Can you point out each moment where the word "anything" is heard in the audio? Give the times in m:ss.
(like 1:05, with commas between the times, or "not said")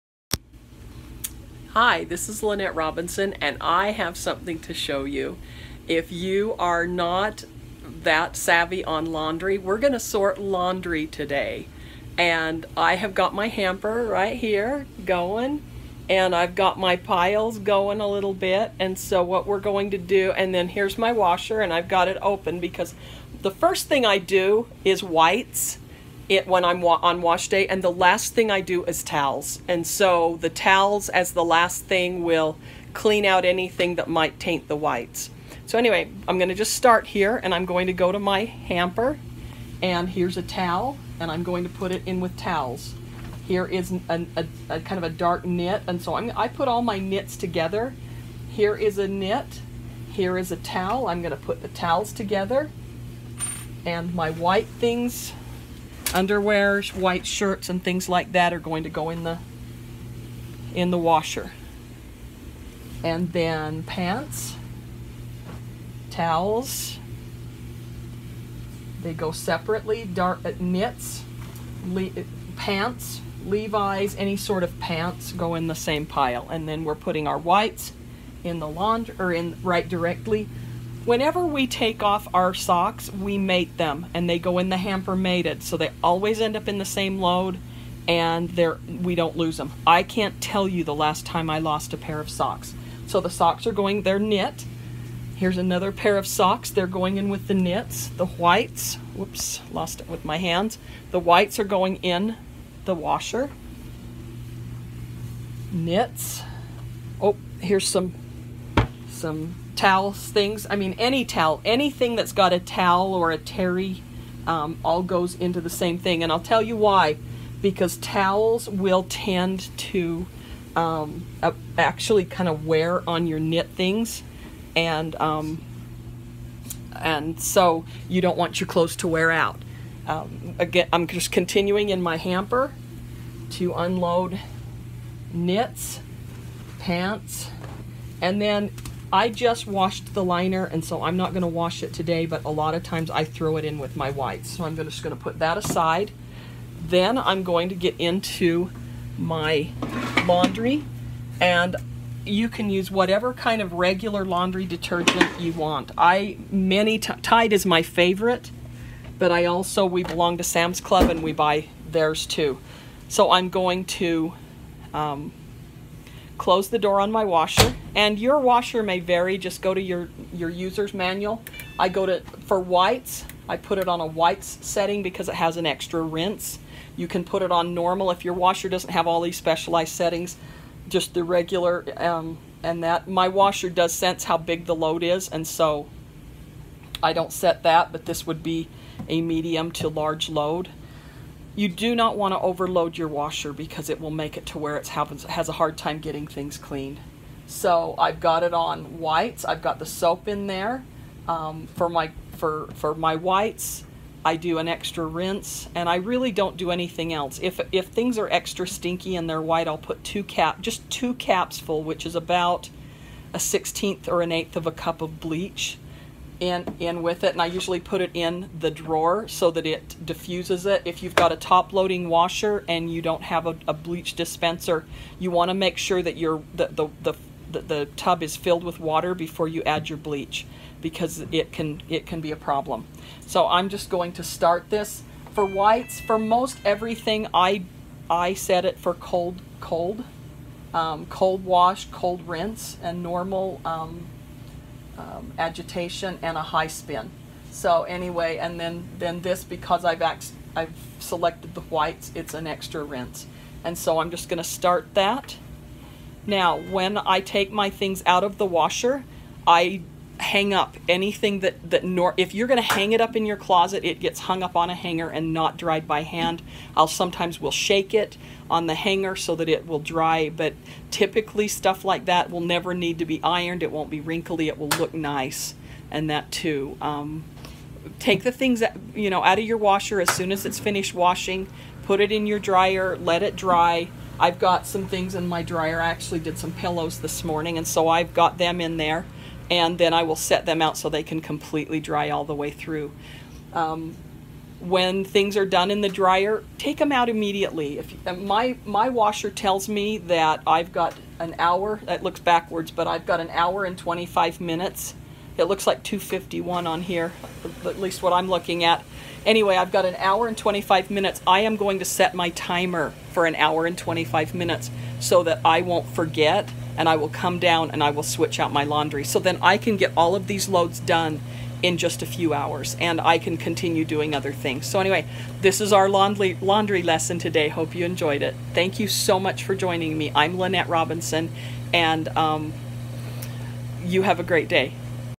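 0:33, 1:51, 3:26, 4:20.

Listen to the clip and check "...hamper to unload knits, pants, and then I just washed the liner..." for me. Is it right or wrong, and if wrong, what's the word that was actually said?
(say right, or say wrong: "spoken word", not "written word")
right.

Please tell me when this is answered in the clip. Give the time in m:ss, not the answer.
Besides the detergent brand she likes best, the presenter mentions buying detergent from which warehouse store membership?
2:40.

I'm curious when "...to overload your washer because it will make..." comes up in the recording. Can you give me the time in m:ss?
3:12.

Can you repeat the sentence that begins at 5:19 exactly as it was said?
So then I can get all of these loads done in just a few hours and I can continue doing other things.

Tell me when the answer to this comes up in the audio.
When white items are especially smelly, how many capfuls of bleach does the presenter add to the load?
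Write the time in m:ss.
3:30.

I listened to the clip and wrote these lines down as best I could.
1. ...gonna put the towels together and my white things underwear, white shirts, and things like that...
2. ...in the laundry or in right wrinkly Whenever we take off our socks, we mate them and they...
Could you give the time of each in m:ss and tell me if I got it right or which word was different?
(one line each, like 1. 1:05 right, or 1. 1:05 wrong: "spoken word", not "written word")
1. 0:51 right
2. 1:18 wrong: "directly", not "wrinkly".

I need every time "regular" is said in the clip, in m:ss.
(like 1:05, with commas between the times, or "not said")
2:33, 3:01.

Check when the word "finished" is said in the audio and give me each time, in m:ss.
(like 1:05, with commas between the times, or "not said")
4:40.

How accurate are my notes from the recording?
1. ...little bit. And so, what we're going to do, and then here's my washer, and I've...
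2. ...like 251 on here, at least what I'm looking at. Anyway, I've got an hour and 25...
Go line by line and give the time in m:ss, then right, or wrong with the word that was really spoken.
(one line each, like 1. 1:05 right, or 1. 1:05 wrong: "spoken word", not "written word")
1. 0:18 right
2. 5:05 right.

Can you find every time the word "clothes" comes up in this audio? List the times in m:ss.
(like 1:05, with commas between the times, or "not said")
2:08.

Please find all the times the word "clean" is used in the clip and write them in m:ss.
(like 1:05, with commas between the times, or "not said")
0:32, 3:16.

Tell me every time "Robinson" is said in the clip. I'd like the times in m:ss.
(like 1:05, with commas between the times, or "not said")
0:02, 5:30.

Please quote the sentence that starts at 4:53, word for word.
Um, when things are done in the dryer, take them out immediately.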